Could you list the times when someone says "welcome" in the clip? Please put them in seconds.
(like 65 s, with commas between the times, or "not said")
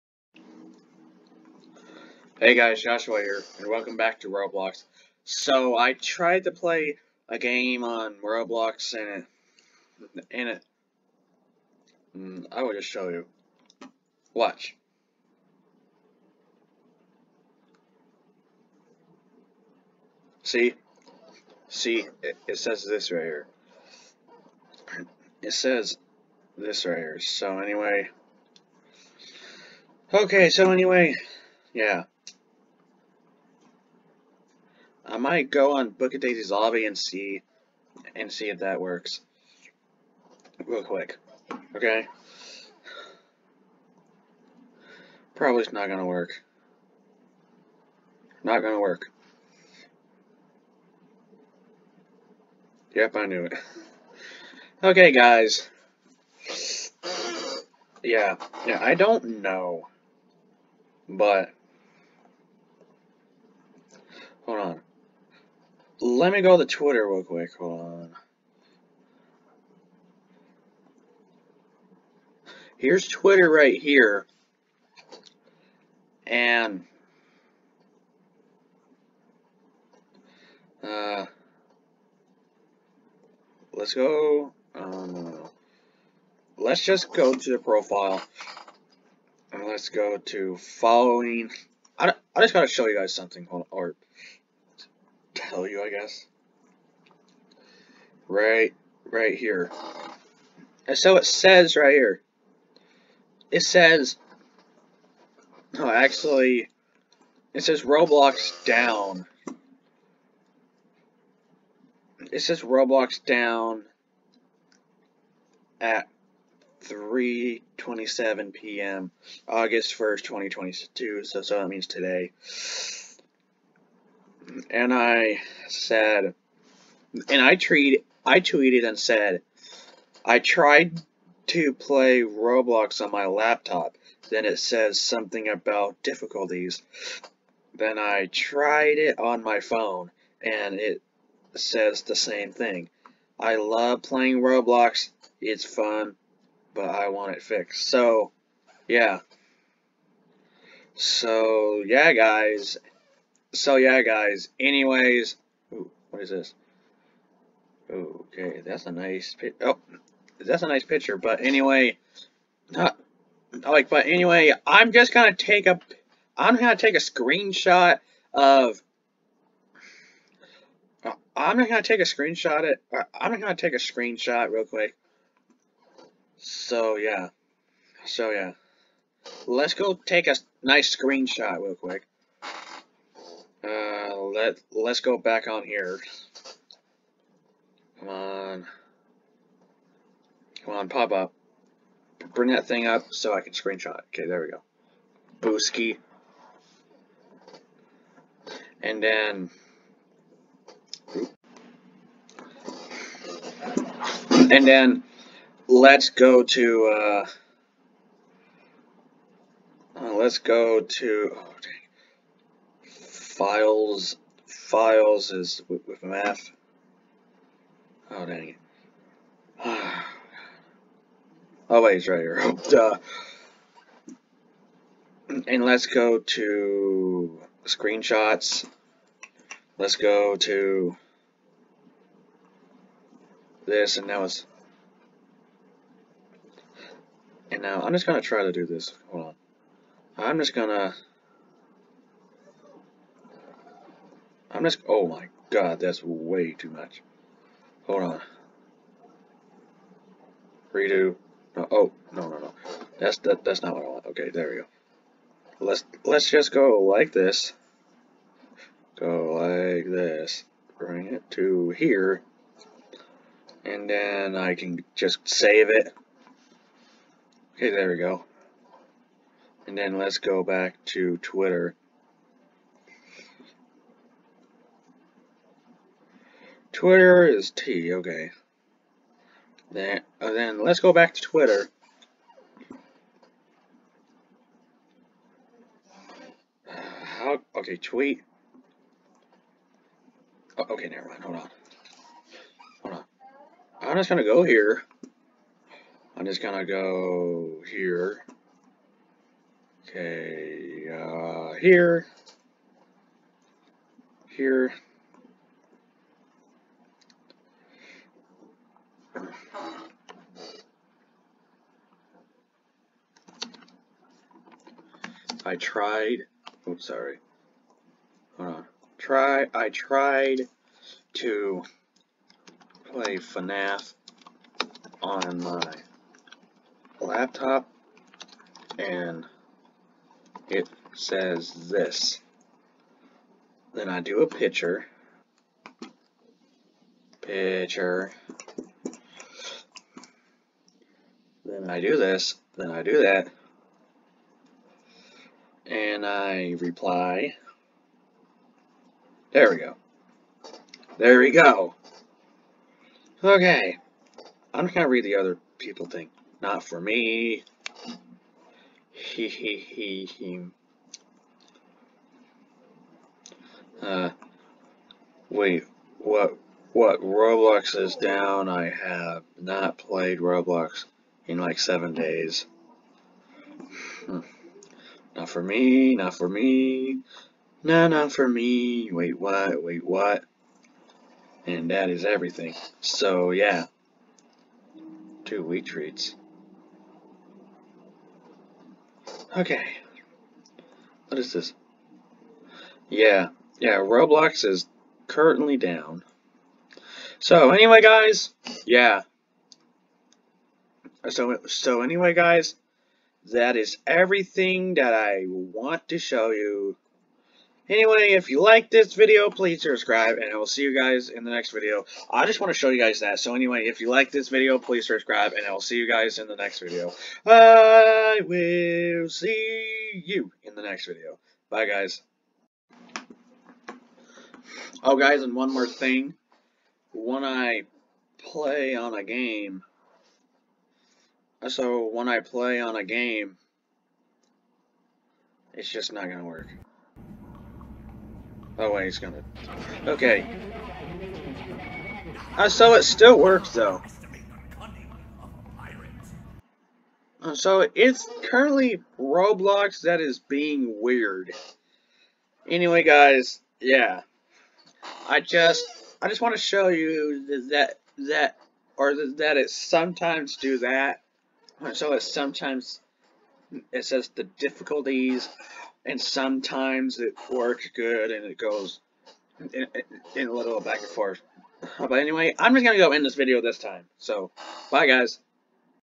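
3 s.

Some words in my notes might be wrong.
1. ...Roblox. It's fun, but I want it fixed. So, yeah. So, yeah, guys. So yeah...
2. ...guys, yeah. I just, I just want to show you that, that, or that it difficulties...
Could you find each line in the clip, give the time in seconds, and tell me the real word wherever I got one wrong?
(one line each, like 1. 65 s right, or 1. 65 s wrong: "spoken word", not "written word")
1. 144 s right
2. 452 s wrong: "sometimes", not "difficulties".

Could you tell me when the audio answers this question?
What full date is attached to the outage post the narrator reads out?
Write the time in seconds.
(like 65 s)
119 s.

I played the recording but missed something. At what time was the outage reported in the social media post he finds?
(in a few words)
3:27 p.m.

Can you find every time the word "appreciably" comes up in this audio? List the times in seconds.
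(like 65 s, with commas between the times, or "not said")
not said.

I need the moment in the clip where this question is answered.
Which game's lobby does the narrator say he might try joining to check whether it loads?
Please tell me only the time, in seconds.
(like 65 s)
35 s.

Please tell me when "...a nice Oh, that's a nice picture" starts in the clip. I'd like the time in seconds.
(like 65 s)
158 s.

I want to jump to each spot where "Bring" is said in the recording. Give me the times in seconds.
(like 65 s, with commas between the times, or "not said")
192 s, 260 s.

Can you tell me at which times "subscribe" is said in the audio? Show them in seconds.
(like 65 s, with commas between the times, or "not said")
409 s, 414 s.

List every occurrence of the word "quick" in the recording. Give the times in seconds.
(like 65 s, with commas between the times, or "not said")
40 s, 67 s, 174 s, 181 s.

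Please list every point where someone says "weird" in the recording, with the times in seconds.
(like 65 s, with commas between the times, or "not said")
450 s.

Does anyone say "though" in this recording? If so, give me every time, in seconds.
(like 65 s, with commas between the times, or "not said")
443 s.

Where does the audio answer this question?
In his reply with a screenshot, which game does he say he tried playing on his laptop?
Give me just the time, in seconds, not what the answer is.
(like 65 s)
323 s.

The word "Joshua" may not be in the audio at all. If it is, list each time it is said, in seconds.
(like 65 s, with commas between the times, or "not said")
2 s.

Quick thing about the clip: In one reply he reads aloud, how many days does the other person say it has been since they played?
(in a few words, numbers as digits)
7.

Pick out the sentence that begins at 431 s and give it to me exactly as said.
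So when I play on a game, it's just not gonna work.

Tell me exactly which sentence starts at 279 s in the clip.
Then, uh, then let's go back to Twitter.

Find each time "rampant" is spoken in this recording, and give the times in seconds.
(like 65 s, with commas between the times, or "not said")
not said.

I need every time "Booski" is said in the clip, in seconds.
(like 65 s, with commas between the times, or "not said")
195 s.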